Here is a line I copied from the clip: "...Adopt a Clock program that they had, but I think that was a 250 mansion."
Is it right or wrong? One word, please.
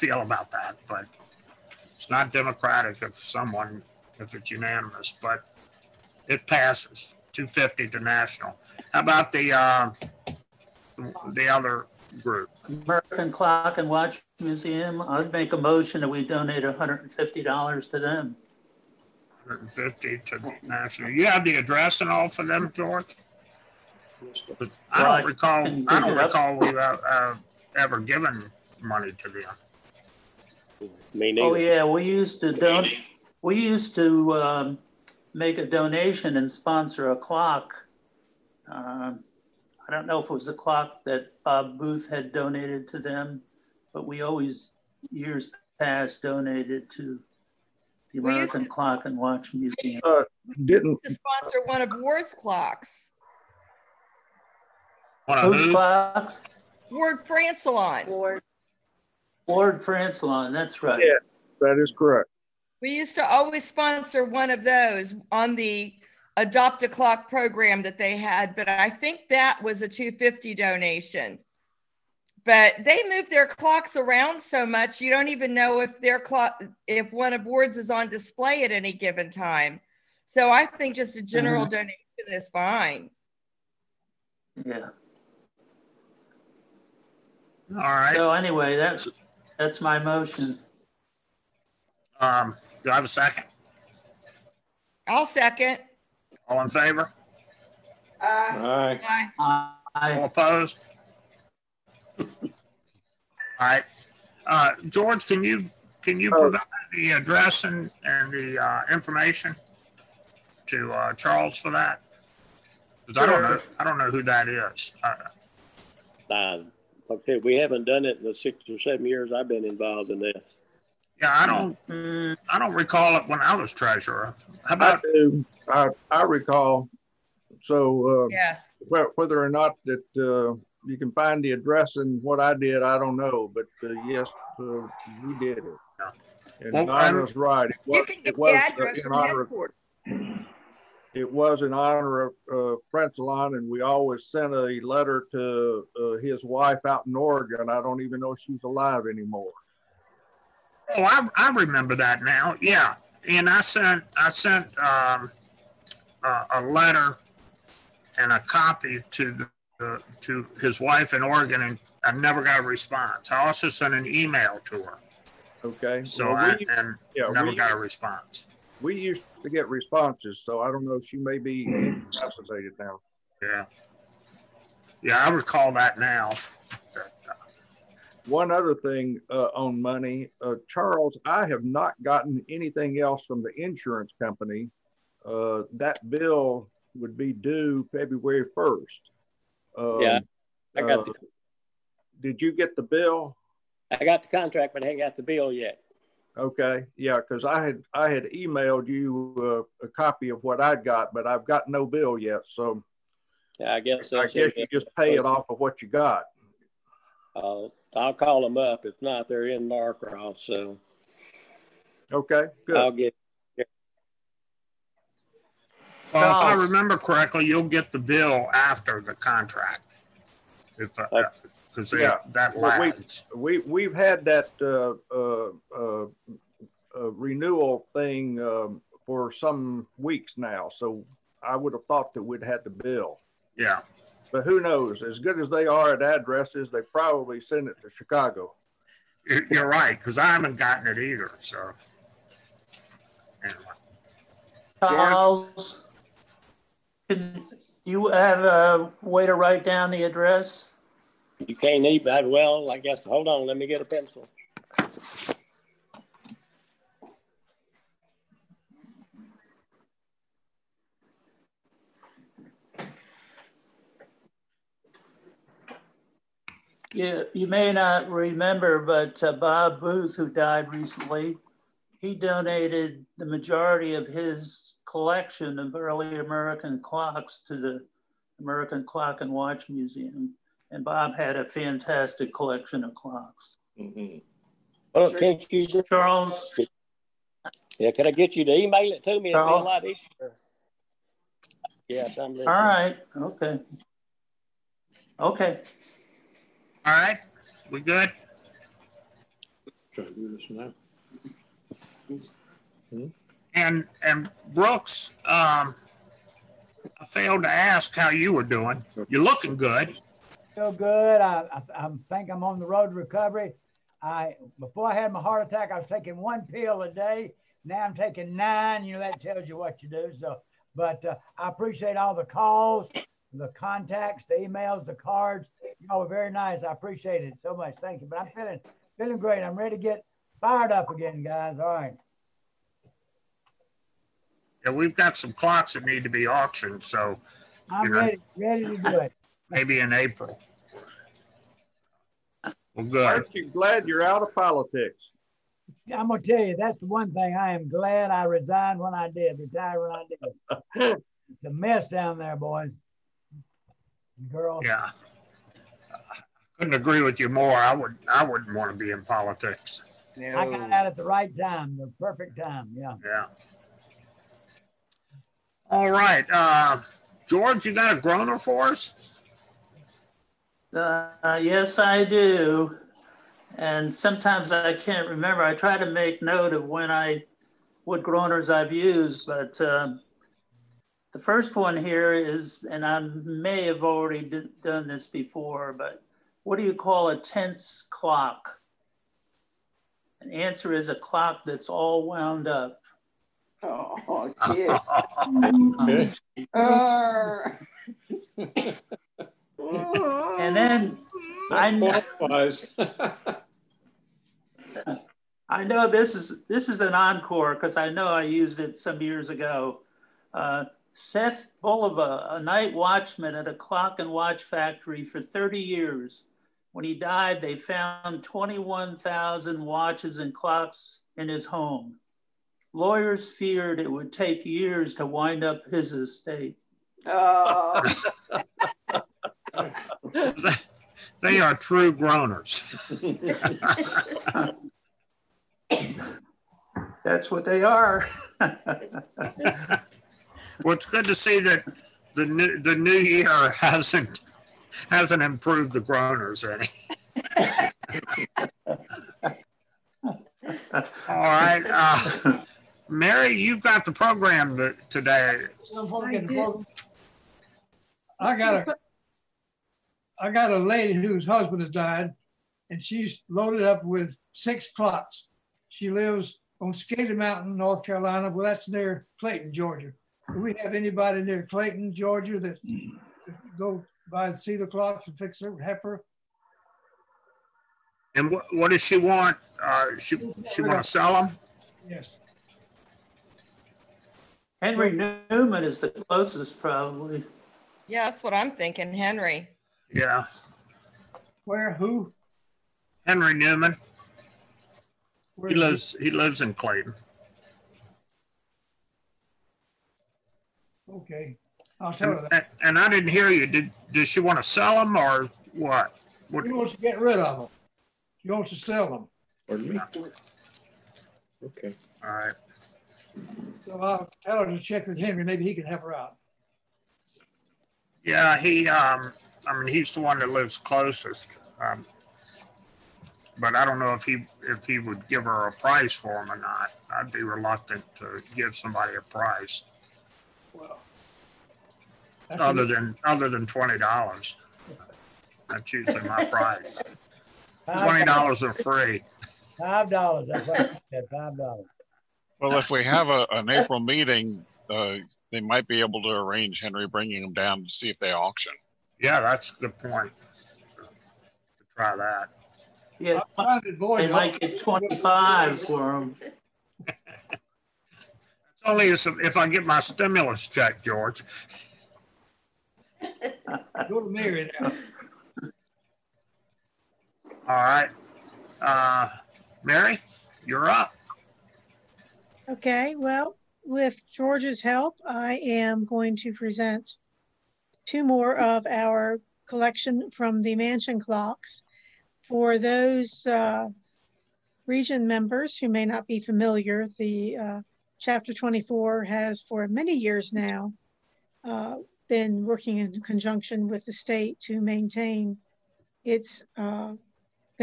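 wrong.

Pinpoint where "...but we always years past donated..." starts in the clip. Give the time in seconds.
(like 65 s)
43 s.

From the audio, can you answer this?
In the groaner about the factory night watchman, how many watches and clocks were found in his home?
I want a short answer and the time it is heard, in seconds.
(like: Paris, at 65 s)
21,000, at 418 s.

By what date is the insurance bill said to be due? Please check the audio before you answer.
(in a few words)
February 1st.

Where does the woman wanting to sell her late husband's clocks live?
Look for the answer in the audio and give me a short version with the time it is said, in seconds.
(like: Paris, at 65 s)
Scaly Mountain, North Carolina, at 466 s.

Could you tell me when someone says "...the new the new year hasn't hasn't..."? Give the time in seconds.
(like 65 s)
442 s.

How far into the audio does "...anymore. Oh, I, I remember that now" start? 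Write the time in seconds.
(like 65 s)
149 s.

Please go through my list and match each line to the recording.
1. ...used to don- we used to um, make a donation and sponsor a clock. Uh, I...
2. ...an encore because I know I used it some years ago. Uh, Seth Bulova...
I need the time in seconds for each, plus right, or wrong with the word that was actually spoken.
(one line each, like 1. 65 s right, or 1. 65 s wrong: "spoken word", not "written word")
1. 32 s right
2. 406 s right.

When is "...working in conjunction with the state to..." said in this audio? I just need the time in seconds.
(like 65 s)
592 s.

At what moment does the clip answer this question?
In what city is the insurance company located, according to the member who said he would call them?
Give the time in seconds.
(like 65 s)
209 s.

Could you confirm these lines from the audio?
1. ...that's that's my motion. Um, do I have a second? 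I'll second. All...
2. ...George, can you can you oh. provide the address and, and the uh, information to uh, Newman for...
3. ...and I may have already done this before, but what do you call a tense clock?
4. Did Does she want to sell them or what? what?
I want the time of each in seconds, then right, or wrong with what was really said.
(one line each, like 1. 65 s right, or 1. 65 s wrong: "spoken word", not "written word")
1. 88 s right
2. 104 s wrong: "Charles", not "Newman"
3. 382 s right
4. 503 s right.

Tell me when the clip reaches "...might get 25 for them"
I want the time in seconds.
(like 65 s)
554 s.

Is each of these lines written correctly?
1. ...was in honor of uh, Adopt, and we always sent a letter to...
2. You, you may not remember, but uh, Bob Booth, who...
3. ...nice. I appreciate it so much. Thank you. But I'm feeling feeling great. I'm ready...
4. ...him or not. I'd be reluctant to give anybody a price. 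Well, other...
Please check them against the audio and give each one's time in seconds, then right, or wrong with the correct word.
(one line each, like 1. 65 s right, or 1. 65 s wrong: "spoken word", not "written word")
1. 141 s wrong: "Francillon", not "Adopt"
2. 266 s right
3. 326 s right
4. 526 s wrong: "somebody", not "anybody".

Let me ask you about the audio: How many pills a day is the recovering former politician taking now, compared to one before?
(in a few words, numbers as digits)
9.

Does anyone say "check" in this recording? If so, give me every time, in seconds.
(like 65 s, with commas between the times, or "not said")
514 s, 560 s.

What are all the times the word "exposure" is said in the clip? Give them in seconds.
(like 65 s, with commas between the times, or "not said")
not said.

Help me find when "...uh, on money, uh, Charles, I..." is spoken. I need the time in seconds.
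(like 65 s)
179 s.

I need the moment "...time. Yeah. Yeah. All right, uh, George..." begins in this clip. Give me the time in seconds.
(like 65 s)
362 s.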